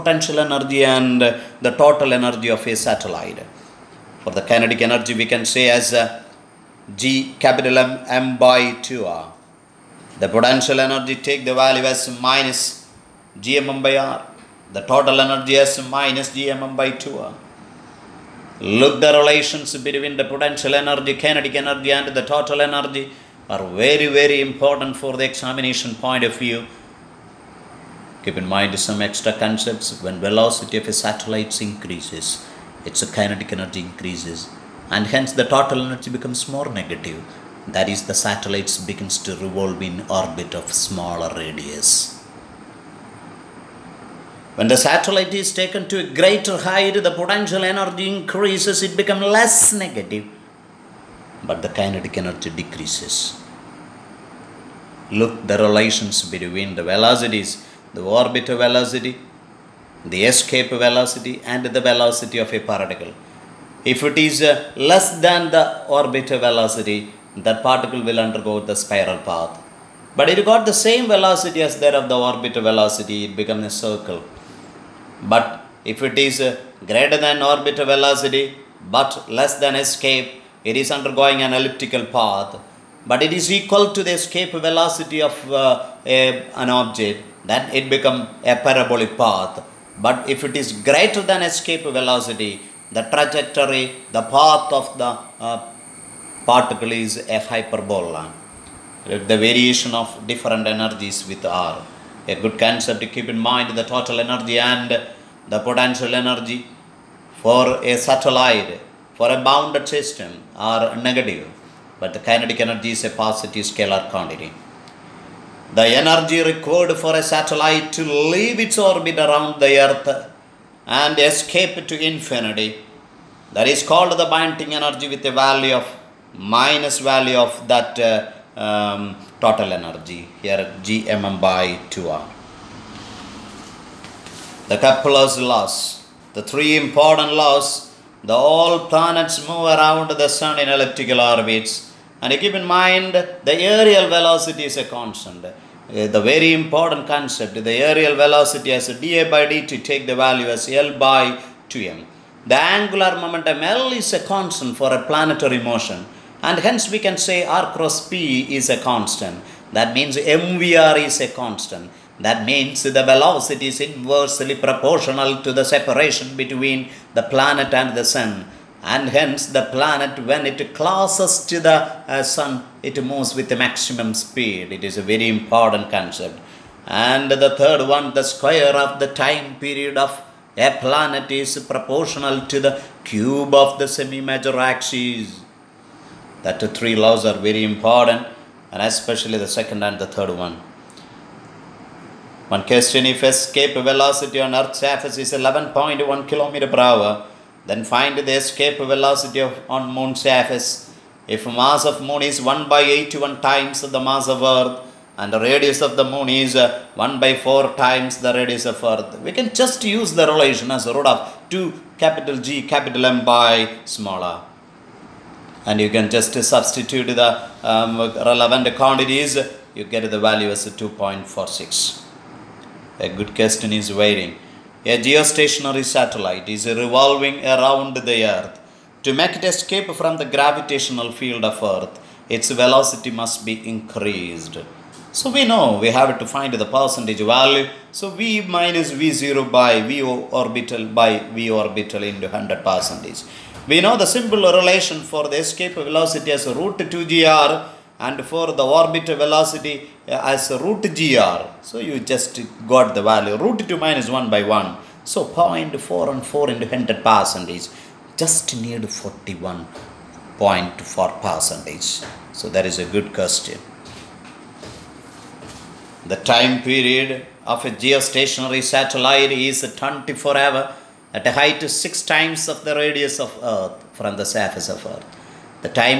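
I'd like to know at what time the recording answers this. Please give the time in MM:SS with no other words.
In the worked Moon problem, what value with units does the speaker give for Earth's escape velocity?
03:15.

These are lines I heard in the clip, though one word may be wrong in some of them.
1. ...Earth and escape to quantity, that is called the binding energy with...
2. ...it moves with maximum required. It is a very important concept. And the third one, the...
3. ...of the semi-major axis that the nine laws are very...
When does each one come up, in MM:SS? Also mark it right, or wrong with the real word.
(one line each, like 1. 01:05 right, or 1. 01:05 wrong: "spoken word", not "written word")
1. 01:59 wrong: "infinity", not "quantity"
2. 02:52 wrong: "speed", not "required"
3. 03:03 wrong: "three", not "nine".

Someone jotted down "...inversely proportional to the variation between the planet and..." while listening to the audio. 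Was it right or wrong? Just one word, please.
wrong.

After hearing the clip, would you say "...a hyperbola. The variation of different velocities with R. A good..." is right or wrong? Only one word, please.
wrong.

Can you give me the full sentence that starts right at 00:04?
For the kinetic energy we can say as uh, G capital M M by 2R.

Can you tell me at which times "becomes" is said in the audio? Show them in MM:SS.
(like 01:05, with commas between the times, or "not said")
00:36, 00:48, 01:13, 01:27.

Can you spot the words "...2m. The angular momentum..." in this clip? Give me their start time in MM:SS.
02:31.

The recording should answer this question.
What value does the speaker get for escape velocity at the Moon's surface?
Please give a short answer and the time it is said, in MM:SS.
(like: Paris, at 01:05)
2.46, at 03:40.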